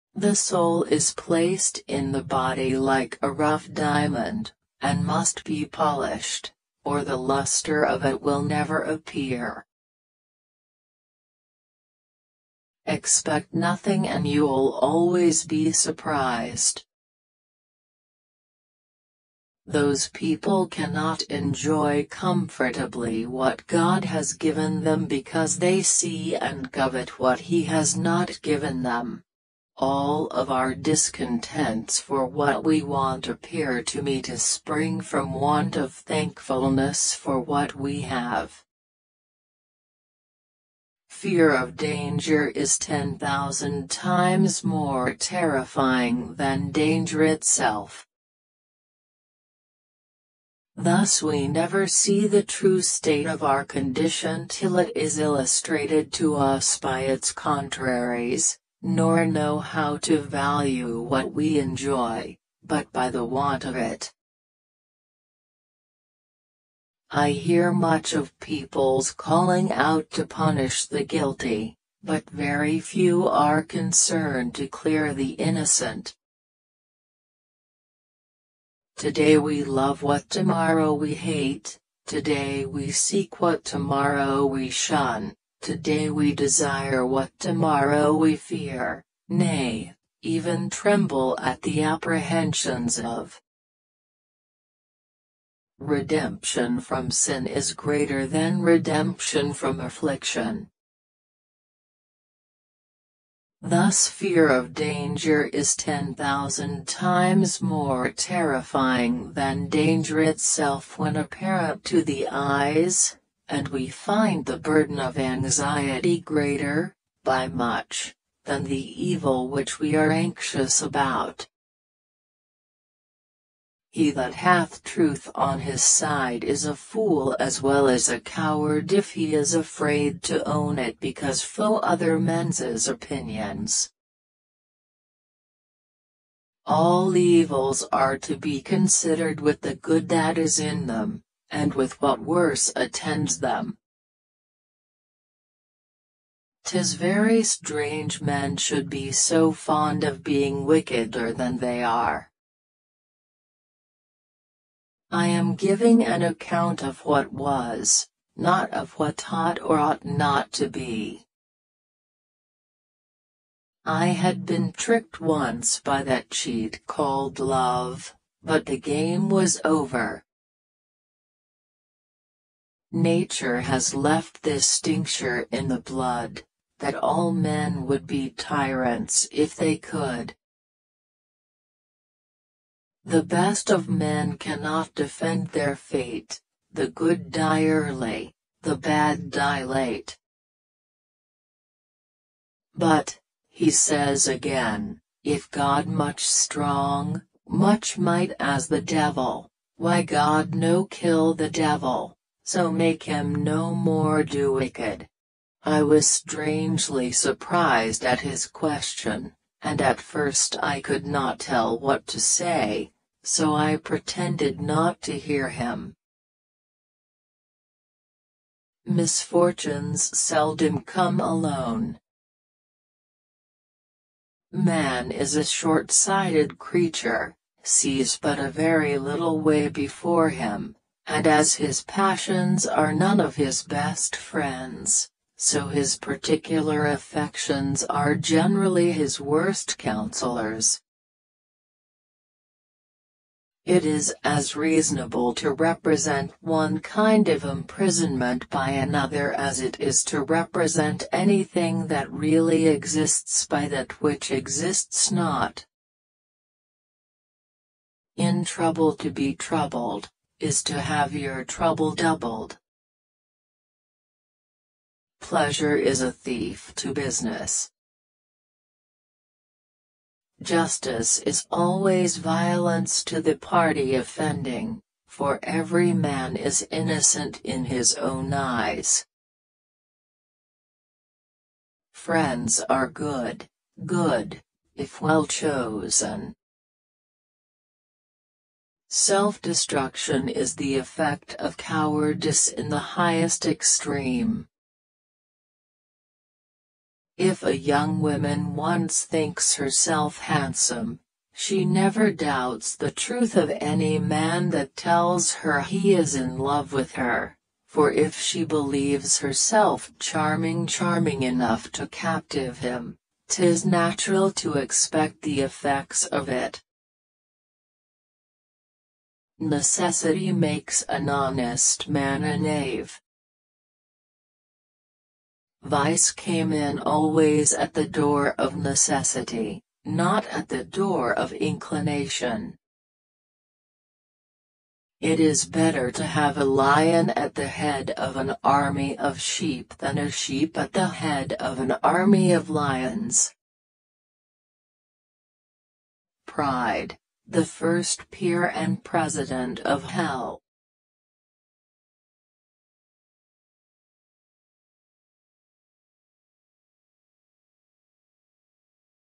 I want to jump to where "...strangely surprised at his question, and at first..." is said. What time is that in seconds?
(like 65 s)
206 s.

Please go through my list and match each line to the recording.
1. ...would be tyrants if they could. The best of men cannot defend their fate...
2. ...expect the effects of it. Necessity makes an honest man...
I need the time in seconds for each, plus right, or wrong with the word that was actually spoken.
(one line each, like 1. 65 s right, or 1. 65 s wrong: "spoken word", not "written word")
1. 177 s right
2. 314 s right.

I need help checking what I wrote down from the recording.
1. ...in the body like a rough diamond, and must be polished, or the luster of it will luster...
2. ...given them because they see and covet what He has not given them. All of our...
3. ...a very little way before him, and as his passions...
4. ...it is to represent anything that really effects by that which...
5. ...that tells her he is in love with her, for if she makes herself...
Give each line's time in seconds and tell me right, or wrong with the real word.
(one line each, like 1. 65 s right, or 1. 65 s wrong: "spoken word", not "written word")
1. 1 s wrong: "never", not "luster"
2. 24 s right
3. 228 s right
4. 249 s wrong: "exists", not "effects"
5. 304 s wrong: "believes", not "makes".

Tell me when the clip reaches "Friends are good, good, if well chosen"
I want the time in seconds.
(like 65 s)
281 s.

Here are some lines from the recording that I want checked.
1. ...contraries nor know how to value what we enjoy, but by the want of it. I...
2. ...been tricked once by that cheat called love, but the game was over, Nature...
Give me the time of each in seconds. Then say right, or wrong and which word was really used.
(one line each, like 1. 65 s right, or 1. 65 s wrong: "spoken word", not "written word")
1. 57 s right
2. 164 s right.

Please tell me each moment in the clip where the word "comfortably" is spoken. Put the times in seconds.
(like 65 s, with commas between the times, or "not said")
22 s.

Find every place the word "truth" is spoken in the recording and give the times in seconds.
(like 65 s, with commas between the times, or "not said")
124 s, 302 s.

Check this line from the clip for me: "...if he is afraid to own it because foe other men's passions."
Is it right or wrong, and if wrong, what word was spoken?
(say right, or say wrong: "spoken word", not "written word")
wrong: "opinions", not "passions".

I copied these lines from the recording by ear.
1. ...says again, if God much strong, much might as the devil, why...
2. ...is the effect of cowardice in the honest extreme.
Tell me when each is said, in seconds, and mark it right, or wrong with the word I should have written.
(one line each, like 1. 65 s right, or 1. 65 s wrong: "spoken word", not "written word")
1. 193 s right
2. 290 s wrong: "highest", not "honest".